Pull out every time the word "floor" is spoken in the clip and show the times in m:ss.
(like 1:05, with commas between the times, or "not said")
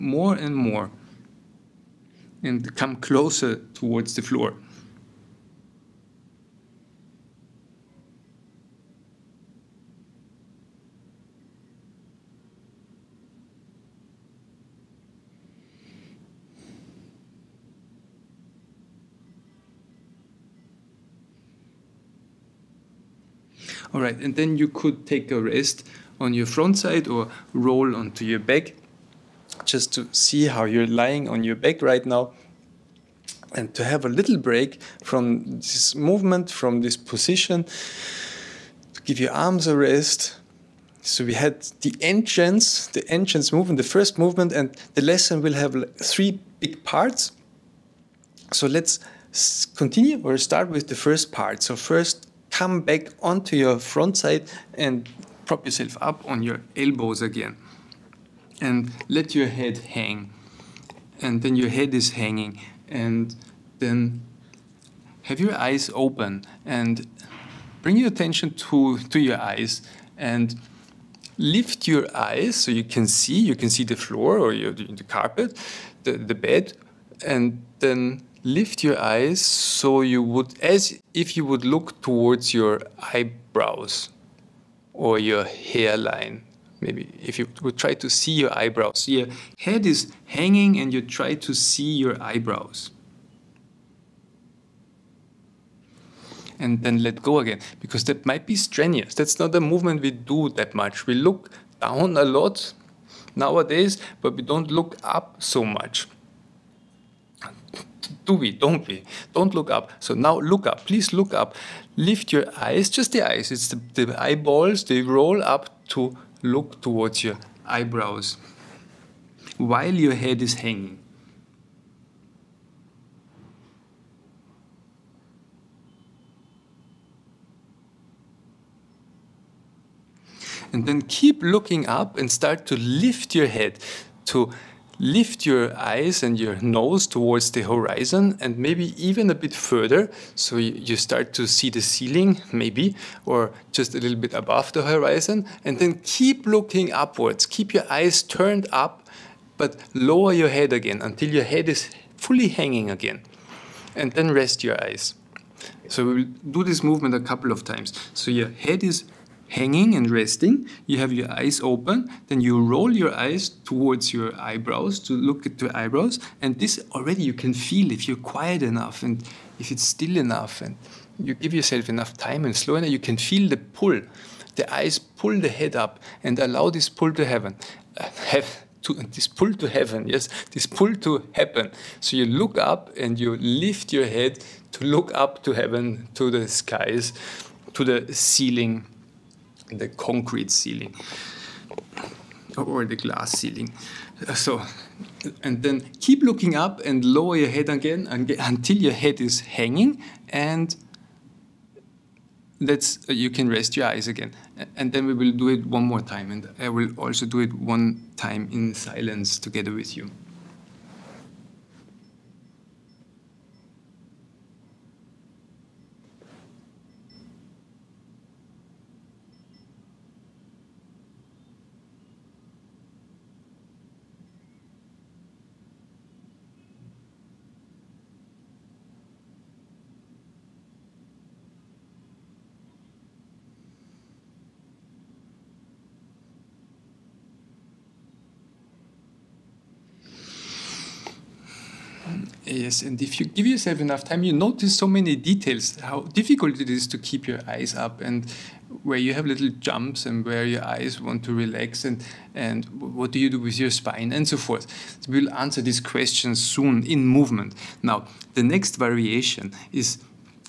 0:04, 1:13.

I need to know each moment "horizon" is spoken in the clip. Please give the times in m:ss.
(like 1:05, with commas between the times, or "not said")
2:17, 2:24.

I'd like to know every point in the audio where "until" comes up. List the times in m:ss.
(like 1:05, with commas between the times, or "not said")
2:31, 3:18.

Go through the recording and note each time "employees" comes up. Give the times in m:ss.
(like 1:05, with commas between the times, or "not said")
not said.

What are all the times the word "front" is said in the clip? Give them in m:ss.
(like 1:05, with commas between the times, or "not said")
0:26, 0:53.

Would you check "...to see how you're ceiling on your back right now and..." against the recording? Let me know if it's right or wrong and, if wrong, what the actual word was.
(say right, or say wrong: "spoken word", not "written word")
wrong: "lying", not "ceiling".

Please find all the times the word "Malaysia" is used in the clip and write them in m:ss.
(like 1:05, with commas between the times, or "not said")
not said.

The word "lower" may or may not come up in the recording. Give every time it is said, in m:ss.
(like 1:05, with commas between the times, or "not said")
2:29, 3:17.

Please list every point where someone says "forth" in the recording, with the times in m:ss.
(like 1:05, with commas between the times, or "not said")
4:14.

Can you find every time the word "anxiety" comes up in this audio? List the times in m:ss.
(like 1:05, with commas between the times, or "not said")
not said.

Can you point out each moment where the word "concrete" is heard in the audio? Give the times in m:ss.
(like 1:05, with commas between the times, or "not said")
3:09.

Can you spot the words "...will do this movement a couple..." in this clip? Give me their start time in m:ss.
2:36.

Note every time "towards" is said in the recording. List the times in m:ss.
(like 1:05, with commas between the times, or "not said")
0:03, 1:22, 1:56, 2:17, 2:43.